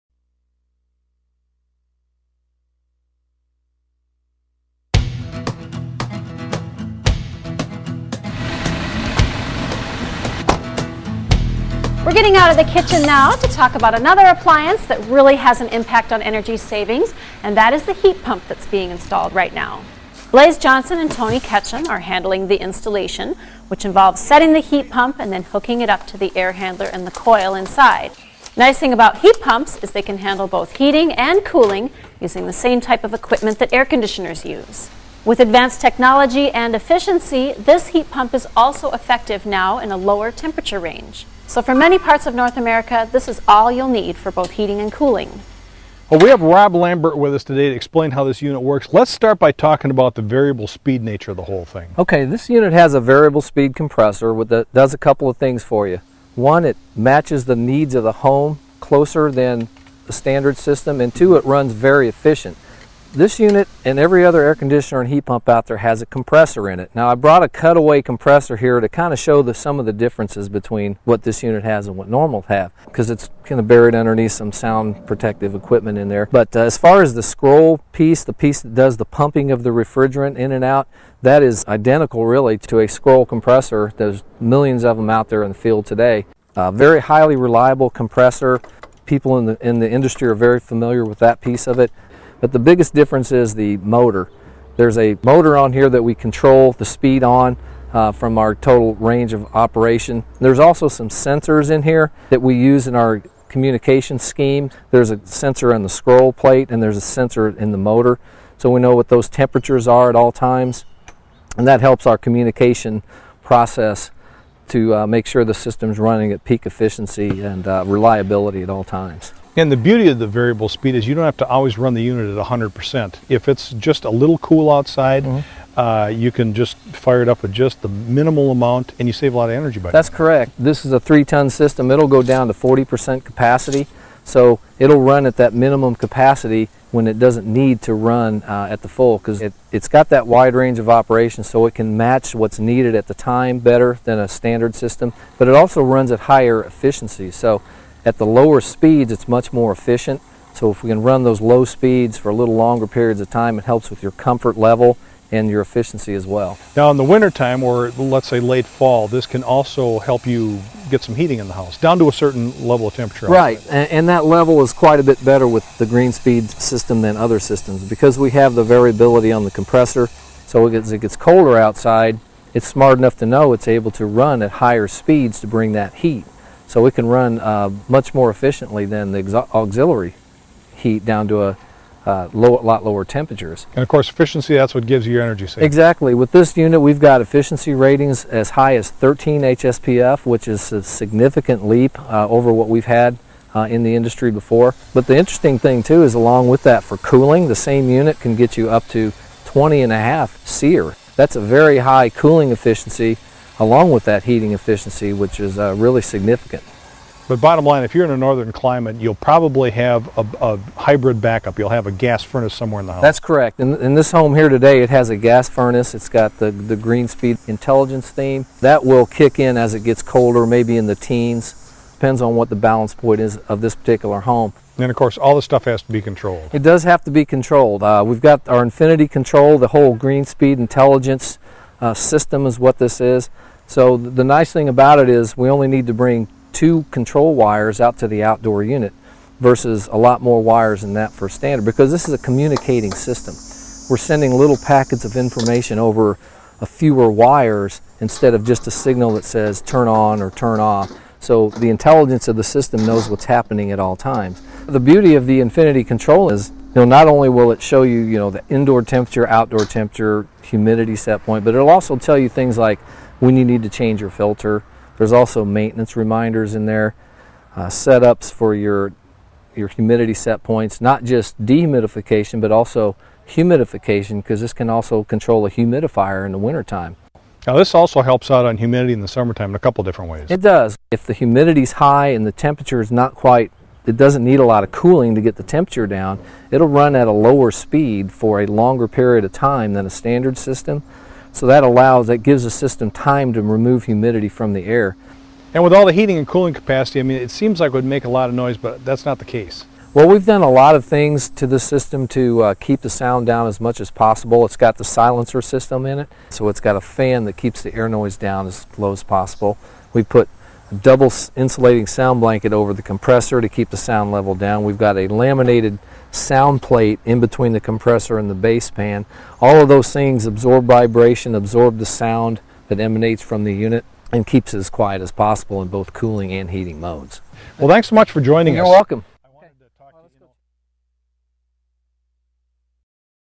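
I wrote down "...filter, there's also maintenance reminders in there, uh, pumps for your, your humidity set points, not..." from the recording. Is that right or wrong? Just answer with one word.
wrong.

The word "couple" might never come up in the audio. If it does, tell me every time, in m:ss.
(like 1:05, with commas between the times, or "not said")
0:54, 4:39.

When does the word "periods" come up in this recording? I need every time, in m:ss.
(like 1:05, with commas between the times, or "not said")
2:32, 4:48.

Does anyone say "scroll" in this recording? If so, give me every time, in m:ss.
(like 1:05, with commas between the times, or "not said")
1:17, 1:22, 1:45.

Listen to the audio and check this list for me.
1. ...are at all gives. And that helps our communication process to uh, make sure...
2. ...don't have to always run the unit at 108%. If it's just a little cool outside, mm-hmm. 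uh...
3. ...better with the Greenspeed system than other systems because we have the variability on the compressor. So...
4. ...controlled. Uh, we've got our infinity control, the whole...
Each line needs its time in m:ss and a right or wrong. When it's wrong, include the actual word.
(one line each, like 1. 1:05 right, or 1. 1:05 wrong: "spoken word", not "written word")
1. 1:49 wrong: "times", not "gives"
2. 2:01 wrong: "100", not "108"
3. 2:45 right
4. 3:47 right.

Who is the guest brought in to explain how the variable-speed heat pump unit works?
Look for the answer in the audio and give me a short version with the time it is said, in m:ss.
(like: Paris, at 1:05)
Rob Lambert, at 0:46.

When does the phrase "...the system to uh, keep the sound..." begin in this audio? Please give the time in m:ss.
5:01.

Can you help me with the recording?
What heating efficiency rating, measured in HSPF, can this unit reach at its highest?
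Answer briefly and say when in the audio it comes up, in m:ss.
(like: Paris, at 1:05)
13 HSPF, at 3:08.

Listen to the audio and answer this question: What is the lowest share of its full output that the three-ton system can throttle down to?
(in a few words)
40%.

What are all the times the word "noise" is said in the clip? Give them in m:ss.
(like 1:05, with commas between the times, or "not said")
4:58, 5:07.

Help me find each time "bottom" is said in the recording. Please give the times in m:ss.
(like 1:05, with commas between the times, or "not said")
3:27.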